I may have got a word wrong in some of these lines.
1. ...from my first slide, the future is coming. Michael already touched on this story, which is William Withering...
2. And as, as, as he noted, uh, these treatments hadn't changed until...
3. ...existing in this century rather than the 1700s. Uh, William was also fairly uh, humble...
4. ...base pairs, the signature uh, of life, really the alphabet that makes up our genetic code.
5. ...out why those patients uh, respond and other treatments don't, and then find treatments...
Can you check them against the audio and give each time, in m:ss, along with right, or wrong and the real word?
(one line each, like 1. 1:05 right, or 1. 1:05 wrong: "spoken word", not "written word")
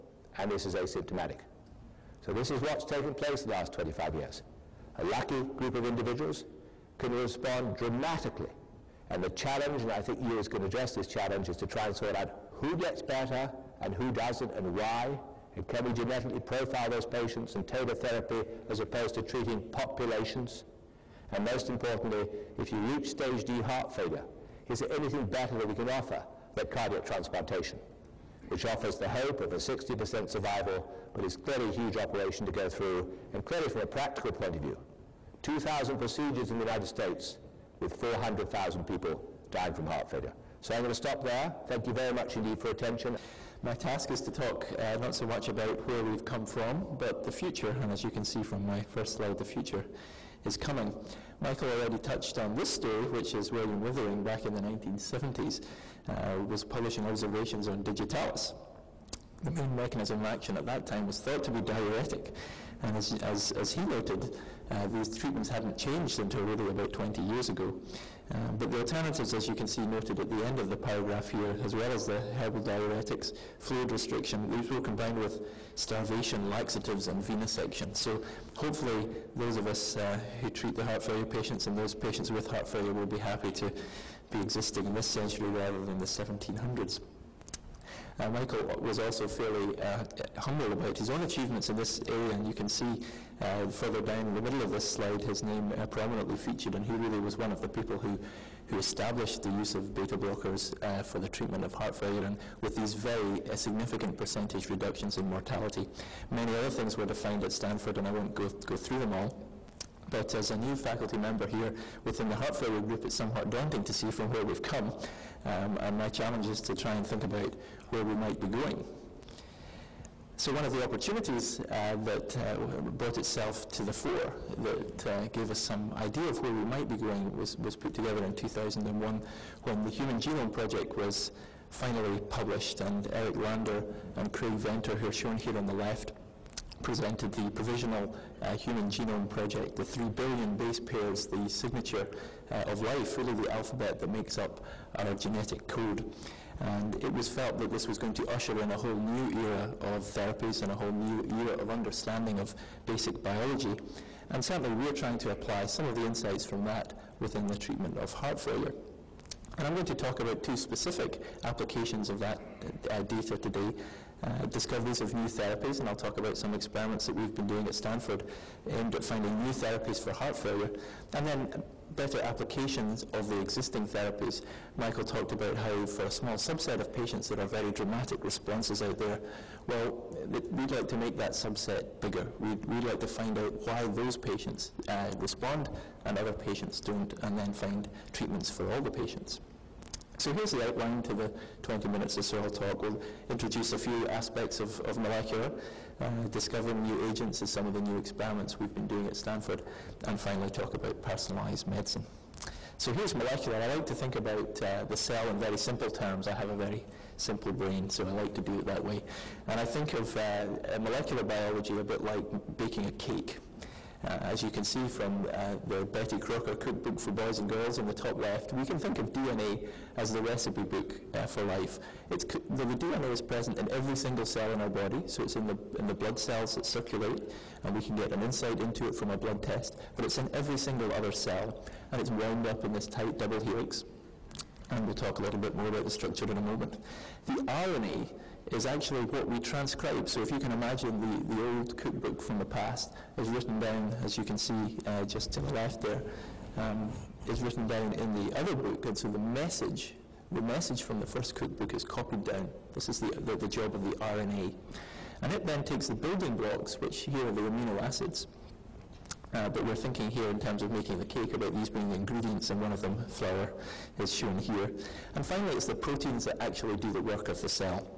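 1. 0:48 right
2. 1:02 right
3. 1:24 wrong: "Michael", not "William"
4. 2:20 right
5. 3:03 wrong: "patients", not "treatments".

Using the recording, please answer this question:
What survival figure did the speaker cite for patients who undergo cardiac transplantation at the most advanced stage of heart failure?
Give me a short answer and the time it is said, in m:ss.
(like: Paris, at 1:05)
60%, at 0:29.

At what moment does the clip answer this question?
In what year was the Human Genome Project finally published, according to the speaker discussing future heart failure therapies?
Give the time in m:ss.
2:08.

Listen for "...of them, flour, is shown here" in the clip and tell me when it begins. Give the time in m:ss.
4:22.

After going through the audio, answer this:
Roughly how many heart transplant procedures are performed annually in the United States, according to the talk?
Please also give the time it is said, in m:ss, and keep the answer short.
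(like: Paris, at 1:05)
2,000, at 0:35.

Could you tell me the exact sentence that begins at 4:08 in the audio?
And so the message, the message from the first cookbook is copied down.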